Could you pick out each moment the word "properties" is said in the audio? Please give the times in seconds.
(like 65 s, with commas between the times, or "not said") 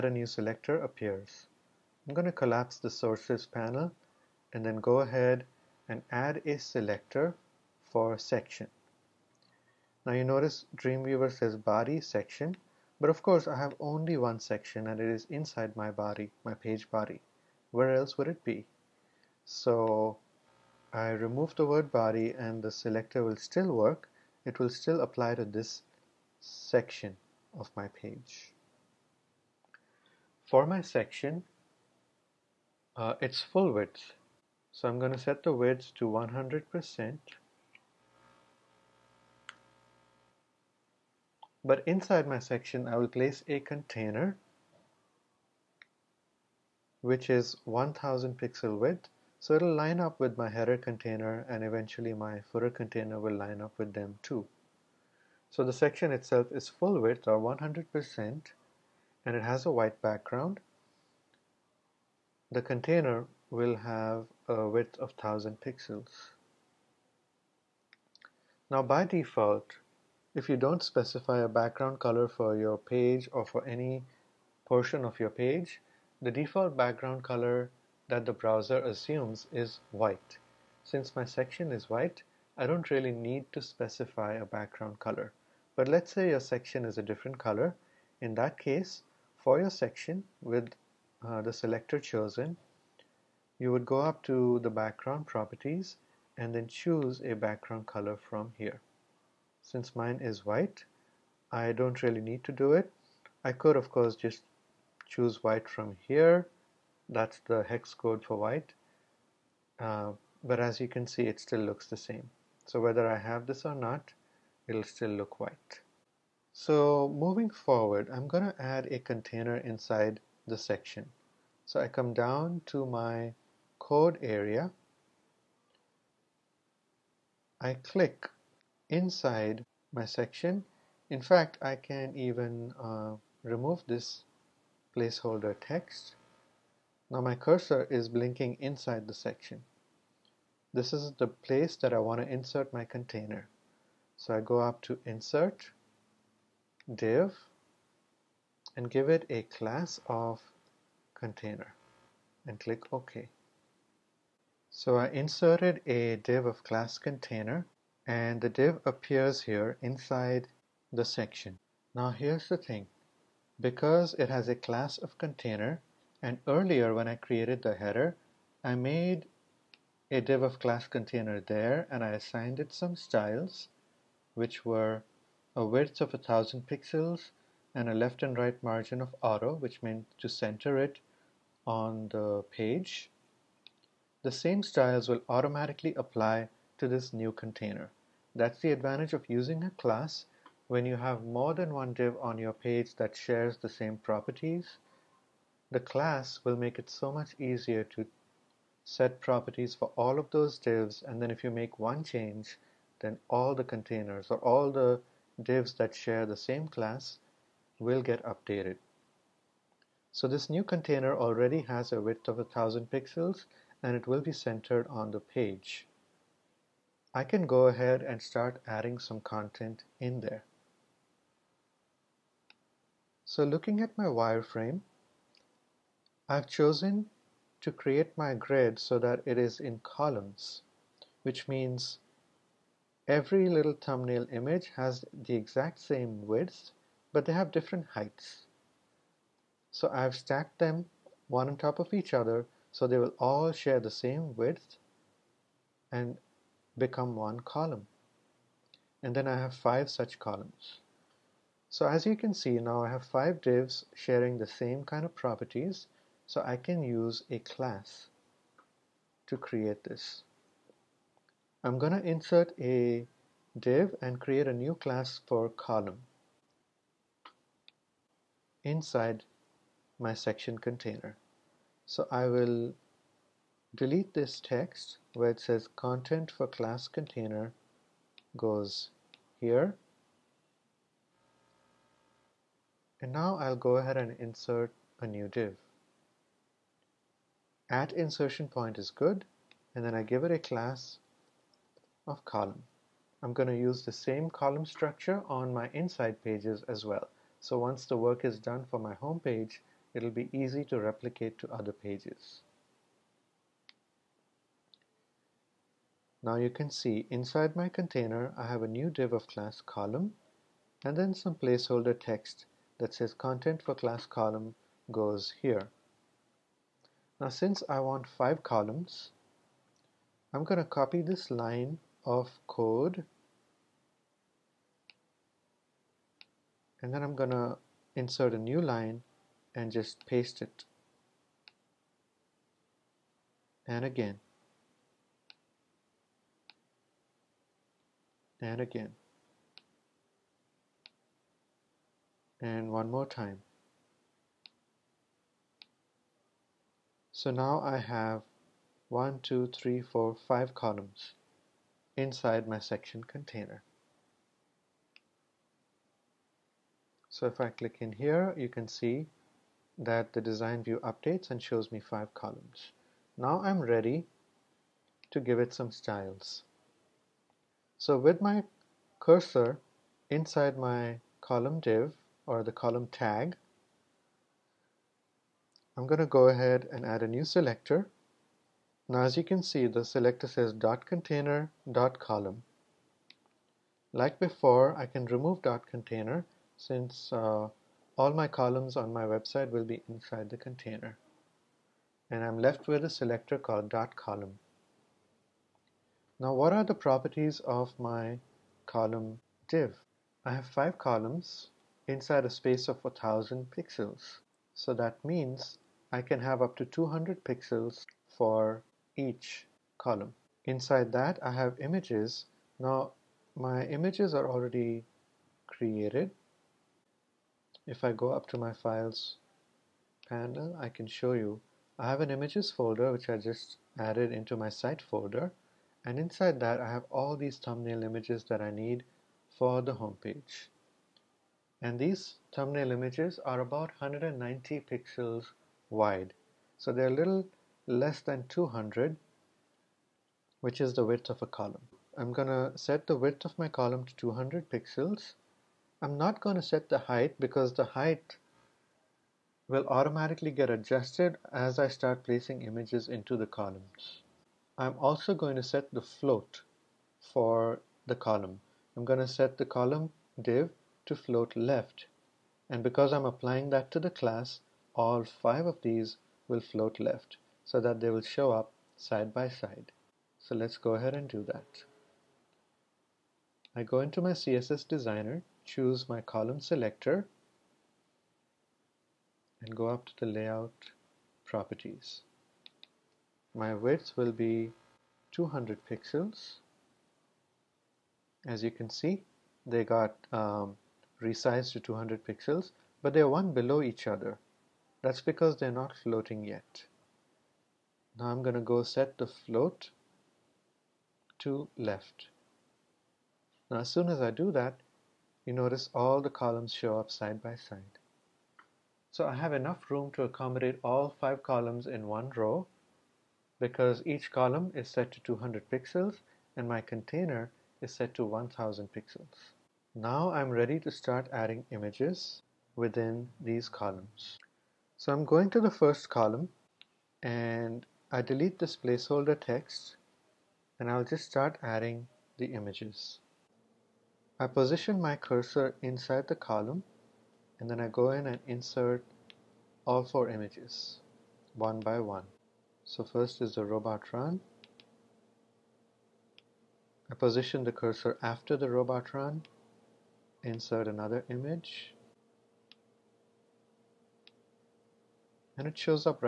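95 s, 193 s, 199 s, 255 s, 396 s, 481 s.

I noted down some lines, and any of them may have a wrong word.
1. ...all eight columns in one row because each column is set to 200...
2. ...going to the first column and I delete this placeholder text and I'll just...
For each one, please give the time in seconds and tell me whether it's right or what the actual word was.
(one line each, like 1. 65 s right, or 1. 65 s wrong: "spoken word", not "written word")
1. 510 s wrong: "five", not "eight"
2. 525 s right.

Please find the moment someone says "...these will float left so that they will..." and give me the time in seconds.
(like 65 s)
465 s.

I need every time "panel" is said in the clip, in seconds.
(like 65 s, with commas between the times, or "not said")
3 s, 420 s.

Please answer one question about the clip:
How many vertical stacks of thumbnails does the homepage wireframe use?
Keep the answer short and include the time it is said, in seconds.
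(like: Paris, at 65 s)
5, at 249 s.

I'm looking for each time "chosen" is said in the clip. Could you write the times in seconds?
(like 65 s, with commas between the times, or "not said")
91 s, 226 s.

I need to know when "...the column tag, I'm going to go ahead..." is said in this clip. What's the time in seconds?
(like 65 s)
372 s.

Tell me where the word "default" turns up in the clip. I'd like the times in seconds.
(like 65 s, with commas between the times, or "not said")
69 s, 76 s.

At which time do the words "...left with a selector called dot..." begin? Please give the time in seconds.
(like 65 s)
392 s.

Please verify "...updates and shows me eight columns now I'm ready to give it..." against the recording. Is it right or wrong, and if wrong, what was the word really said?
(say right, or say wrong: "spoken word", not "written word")
wrong: "five", not "eight".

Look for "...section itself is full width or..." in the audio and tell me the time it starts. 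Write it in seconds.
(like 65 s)
55 s.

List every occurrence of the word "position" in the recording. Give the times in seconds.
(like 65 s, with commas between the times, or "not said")
534 s, 546 s.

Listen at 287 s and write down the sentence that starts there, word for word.
At insertion point is good, and then I give it a class of column.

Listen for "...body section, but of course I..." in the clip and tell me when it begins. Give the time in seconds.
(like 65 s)
11 s.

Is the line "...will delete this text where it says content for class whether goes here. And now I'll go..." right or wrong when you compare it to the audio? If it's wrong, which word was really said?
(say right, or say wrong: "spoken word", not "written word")
wrong: "container", not "whether".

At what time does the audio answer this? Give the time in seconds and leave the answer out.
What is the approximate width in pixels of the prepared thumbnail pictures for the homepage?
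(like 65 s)
433 s.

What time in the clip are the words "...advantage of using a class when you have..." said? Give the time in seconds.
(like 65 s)
188 s.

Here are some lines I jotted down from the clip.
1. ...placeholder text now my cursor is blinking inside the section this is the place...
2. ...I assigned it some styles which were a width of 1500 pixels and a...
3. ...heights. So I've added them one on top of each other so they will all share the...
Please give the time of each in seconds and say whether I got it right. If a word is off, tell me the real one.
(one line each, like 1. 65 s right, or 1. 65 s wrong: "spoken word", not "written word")
1. 134 s right
2. 172 s wrong: "1000", not "1500"
3. 237 s wrong: "stacked", not "added".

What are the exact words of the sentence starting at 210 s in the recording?
So this new container already has a width of a 1000 pixels and it will be centered on the page.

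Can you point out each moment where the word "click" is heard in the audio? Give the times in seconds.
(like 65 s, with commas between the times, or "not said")
127 s, 152 s, 357 s.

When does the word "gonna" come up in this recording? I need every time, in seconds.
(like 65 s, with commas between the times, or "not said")
442 s, 446 s, 498 s.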